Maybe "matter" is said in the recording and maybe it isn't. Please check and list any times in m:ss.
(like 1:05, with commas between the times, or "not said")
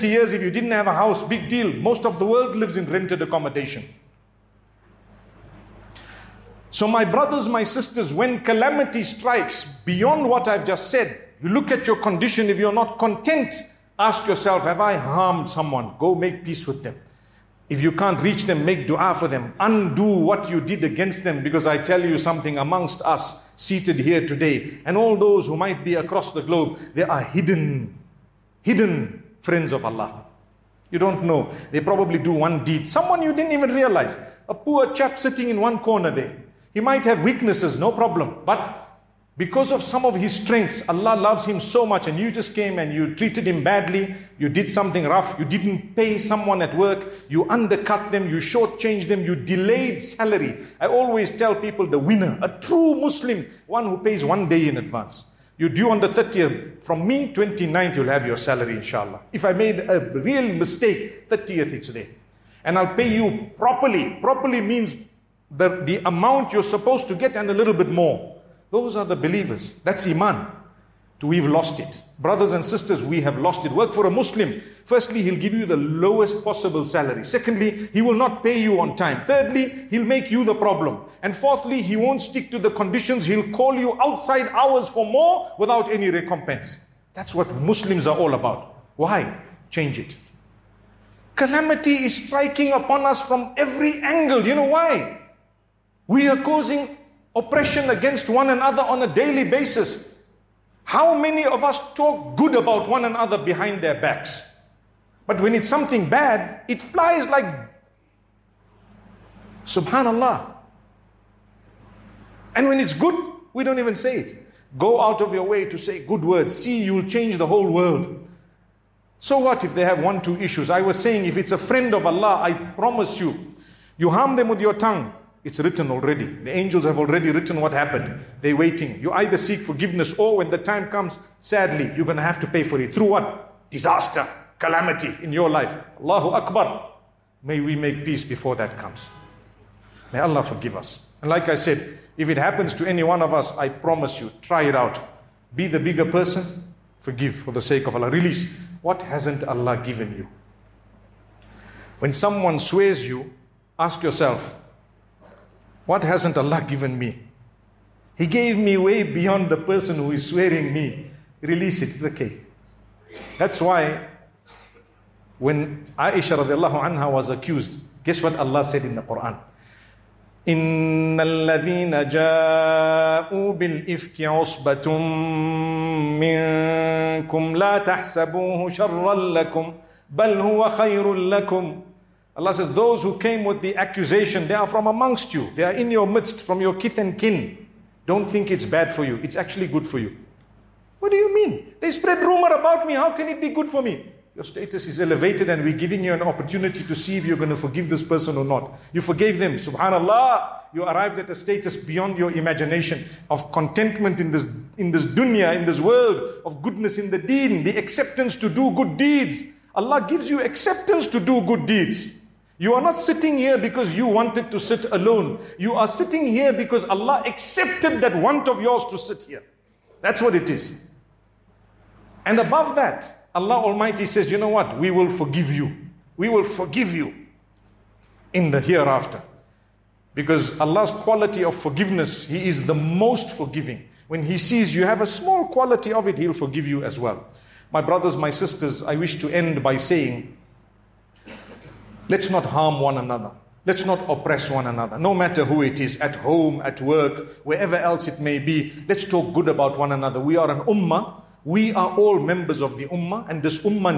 4:05.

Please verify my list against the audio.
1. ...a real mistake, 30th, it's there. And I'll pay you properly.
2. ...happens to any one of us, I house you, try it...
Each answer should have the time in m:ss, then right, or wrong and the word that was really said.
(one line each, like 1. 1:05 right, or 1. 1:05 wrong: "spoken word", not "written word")
1. 0:59 right
2. 2:22 wrong: "promise", not "house".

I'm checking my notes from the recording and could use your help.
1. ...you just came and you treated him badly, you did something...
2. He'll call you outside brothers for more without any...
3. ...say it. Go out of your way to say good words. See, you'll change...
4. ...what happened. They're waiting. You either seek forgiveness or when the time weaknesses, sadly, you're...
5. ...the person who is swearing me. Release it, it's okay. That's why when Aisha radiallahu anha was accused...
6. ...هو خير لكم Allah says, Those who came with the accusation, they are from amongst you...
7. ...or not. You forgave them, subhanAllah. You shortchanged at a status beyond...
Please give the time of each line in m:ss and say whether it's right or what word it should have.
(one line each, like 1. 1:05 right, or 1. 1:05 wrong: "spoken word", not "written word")
1. 0:42 right
2. 1:23 wrong: "hours", not "brothers"
3. 1:53 right
4. 2:07 wrong: "comes", not "weaknesses"
5. 2:39 right
6. 3:00 right
7. 3:18 wrong: "arrived", not "shortchanged".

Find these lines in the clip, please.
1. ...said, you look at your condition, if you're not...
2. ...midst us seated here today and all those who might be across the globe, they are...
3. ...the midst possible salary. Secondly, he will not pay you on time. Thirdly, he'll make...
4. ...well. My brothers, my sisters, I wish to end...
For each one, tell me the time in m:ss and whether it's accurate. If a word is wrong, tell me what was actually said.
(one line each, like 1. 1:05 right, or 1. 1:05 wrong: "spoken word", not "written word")
1. 0:10 right
2. 0:22 wrong: "amongst", not "midst"
3. 1:15 wrong: "lowest", not "midst"
4. 3:57 right.